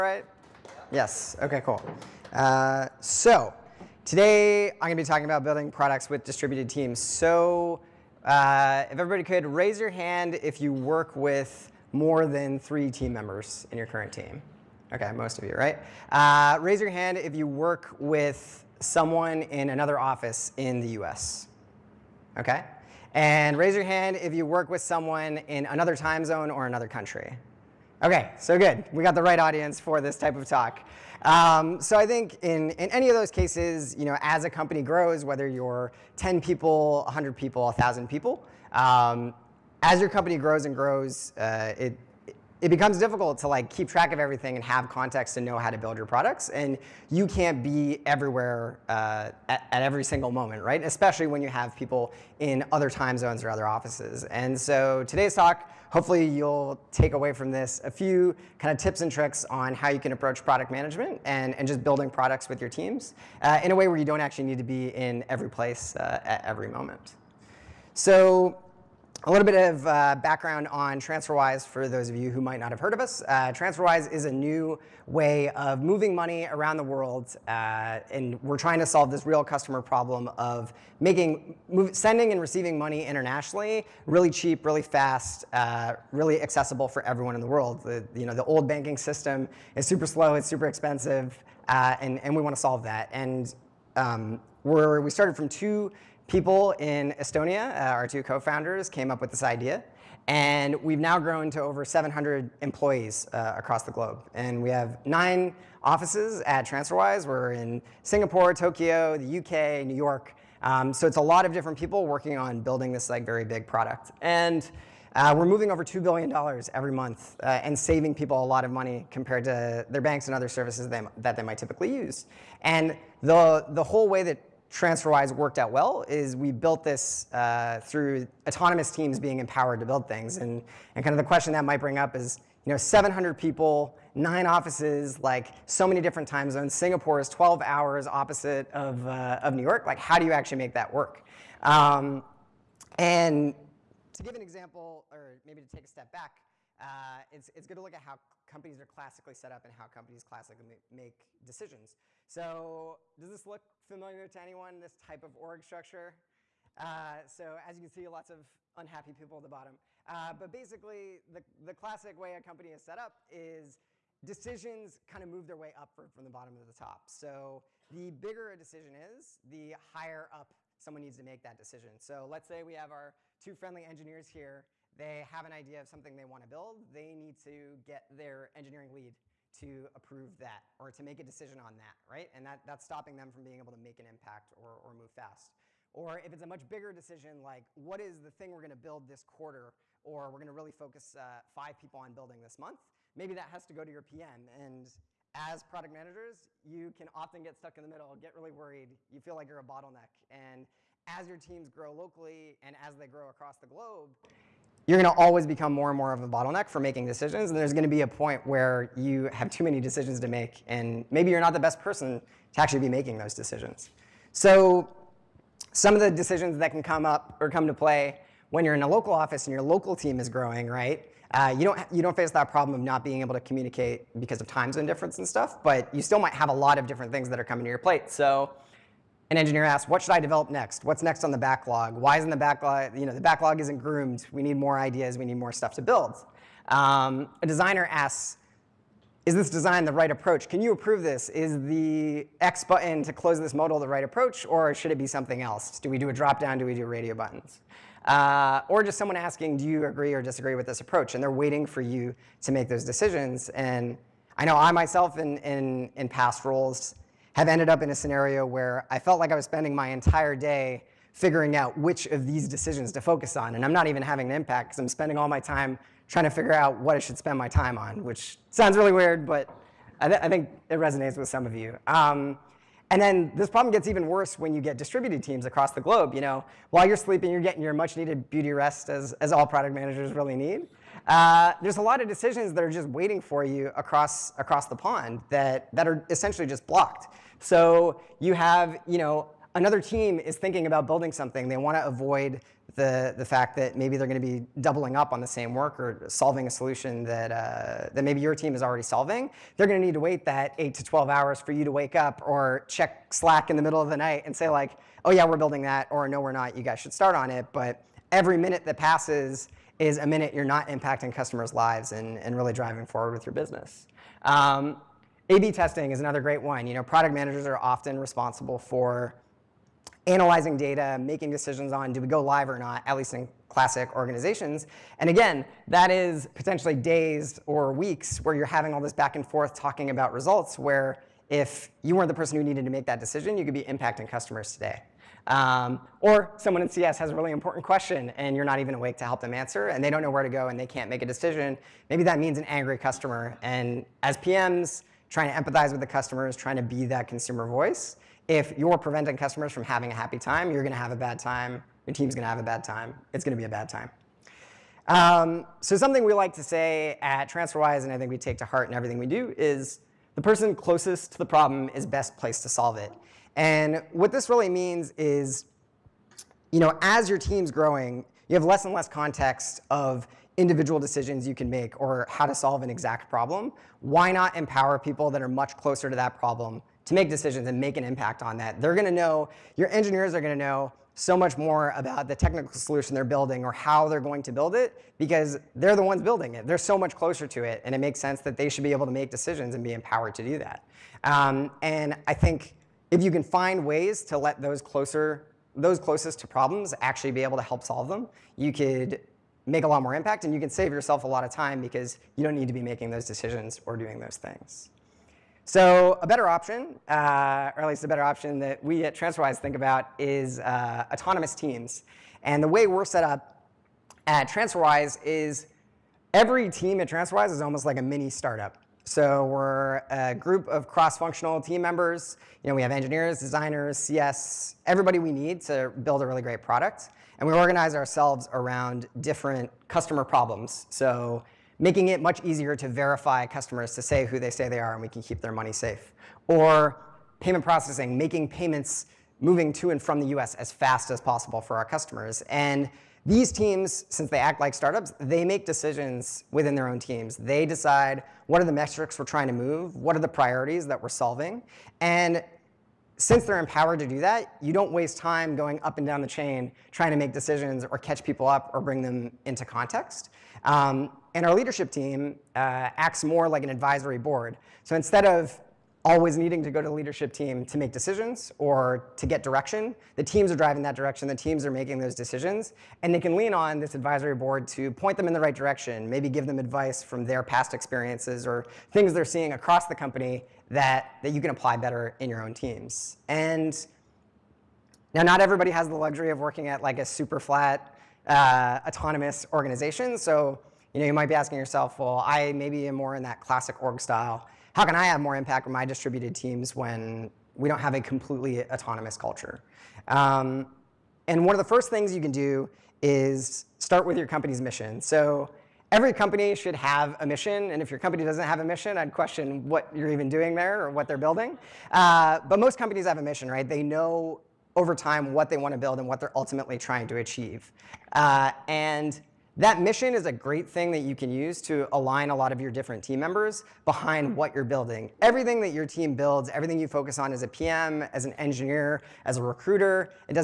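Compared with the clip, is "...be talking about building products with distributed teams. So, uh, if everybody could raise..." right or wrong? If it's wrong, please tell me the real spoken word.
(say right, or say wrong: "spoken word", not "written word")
right.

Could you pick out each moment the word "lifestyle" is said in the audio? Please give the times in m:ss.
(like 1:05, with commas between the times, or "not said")
not said.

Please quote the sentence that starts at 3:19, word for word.
You feel like you're a bottleneck.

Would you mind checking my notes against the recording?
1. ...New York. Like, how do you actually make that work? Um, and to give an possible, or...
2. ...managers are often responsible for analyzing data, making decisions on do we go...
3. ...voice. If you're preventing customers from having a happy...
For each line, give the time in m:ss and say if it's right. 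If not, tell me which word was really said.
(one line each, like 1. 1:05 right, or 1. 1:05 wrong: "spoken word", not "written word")
1. 2:19 wrong: "example", not "possible"
2. 5:17 right
3. 5:47 right.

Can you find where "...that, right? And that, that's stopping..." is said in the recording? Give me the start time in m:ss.
3:01.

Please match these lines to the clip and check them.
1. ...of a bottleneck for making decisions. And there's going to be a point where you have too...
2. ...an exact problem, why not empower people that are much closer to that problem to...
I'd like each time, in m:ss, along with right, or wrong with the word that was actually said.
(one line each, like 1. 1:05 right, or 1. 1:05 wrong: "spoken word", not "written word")
1. 3:26 right
2. 6:12 right.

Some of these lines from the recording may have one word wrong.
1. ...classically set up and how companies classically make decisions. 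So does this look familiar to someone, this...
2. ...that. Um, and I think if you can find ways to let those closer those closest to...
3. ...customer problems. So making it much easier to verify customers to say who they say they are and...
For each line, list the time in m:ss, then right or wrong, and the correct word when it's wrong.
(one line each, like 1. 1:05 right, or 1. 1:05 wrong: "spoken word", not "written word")
1. 2:28 wrong: "anyone", not "someone"
2. 6:30 right
3. 7:09 right.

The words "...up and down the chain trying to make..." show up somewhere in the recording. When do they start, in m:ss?
7:35.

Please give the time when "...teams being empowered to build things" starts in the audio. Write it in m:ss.
2:08.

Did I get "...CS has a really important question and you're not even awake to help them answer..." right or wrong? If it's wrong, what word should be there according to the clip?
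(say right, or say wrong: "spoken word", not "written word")
right.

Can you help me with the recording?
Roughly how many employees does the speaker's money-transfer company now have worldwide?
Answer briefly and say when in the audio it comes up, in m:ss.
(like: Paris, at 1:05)
over 700, at 1:41.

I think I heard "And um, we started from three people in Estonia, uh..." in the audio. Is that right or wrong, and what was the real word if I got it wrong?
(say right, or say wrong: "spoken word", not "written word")
wrong: "two", not "three".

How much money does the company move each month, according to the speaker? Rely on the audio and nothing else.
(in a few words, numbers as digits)
over $2 billion.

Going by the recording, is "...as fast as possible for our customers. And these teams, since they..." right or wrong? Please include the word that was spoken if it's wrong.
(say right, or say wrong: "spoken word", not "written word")
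right.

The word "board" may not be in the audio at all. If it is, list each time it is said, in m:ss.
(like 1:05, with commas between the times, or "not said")
7:43, 7:54.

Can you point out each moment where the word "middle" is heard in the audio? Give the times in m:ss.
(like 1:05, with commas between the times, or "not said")
3:17, 5:03.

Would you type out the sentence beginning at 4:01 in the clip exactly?
Is the X button to close this modal the right approach, or should it be something else?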